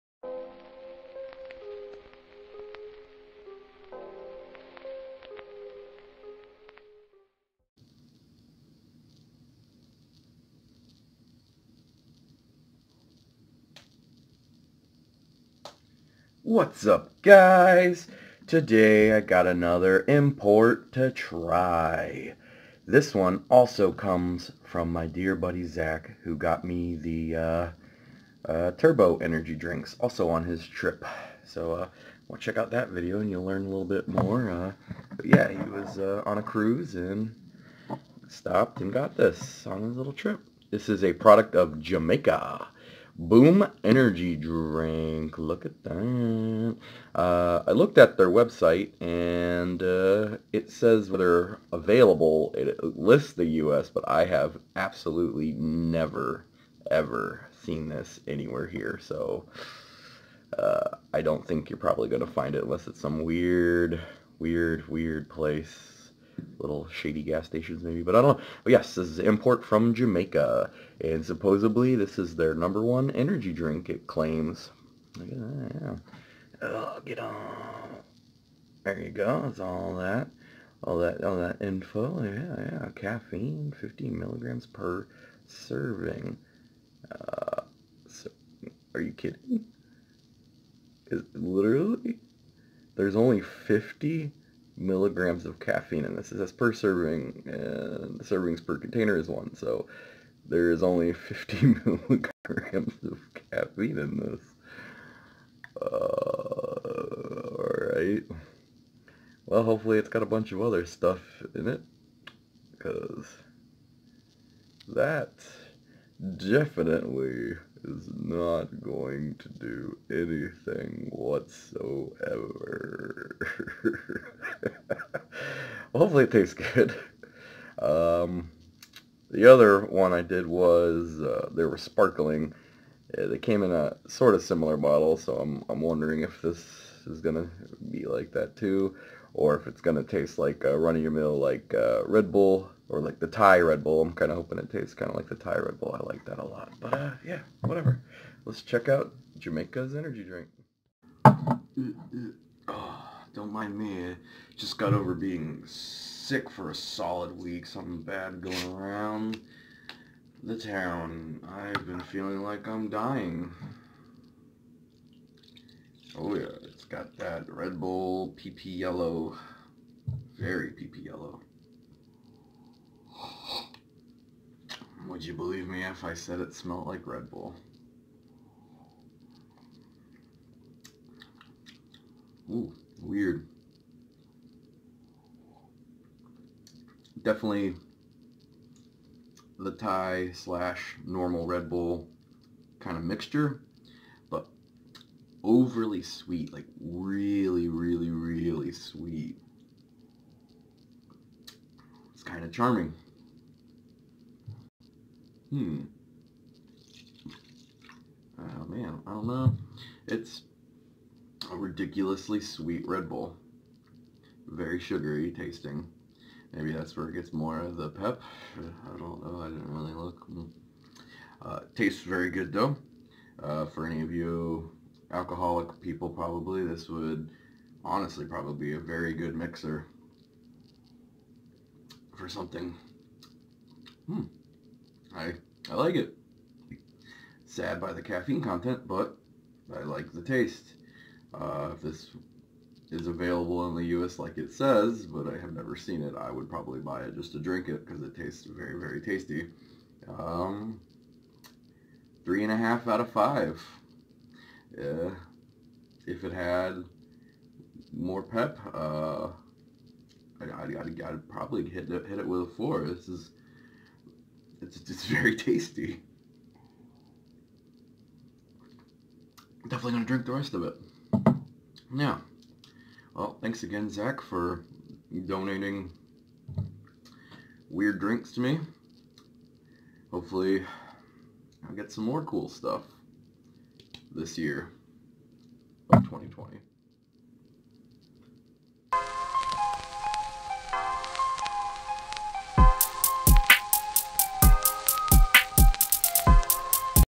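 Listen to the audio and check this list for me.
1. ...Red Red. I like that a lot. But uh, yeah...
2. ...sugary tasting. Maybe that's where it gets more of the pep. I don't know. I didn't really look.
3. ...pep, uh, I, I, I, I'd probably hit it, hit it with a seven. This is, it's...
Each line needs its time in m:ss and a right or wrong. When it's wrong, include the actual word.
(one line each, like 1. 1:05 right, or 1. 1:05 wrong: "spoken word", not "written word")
1. 2:25 wrong: "Bull", not "Red"
2. 3:34 right
3. 4:18 wrong: "four", not "seven".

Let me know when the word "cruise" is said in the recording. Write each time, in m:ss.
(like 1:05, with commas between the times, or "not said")
0:36.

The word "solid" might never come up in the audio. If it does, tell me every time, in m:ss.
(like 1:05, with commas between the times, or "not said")
2:36.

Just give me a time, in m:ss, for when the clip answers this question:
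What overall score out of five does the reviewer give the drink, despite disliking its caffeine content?
4:12.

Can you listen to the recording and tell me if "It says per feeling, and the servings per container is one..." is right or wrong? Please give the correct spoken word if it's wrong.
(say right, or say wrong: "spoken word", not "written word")
wrong: "serving", not "feeling".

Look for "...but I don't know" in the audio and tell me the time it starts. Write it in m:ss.
1:08.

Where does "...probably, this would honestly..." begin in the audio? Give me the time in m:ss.
3:46.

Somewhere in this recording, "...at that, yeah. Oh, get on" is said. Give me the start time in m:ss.
1:15.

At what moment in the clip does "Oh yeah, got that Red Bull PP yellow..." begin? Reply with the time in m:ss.
2:46.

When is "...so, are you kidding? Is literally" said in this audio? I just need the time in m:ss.
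1:28.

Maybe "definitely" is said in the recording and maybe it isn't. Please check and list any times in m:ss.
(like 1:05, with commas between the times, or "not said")
1:56, 3:07, 4:29.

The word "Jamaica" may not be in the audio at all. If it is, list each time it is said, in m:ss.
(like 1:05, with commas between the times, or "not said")
0:41, 1:09, 2:29.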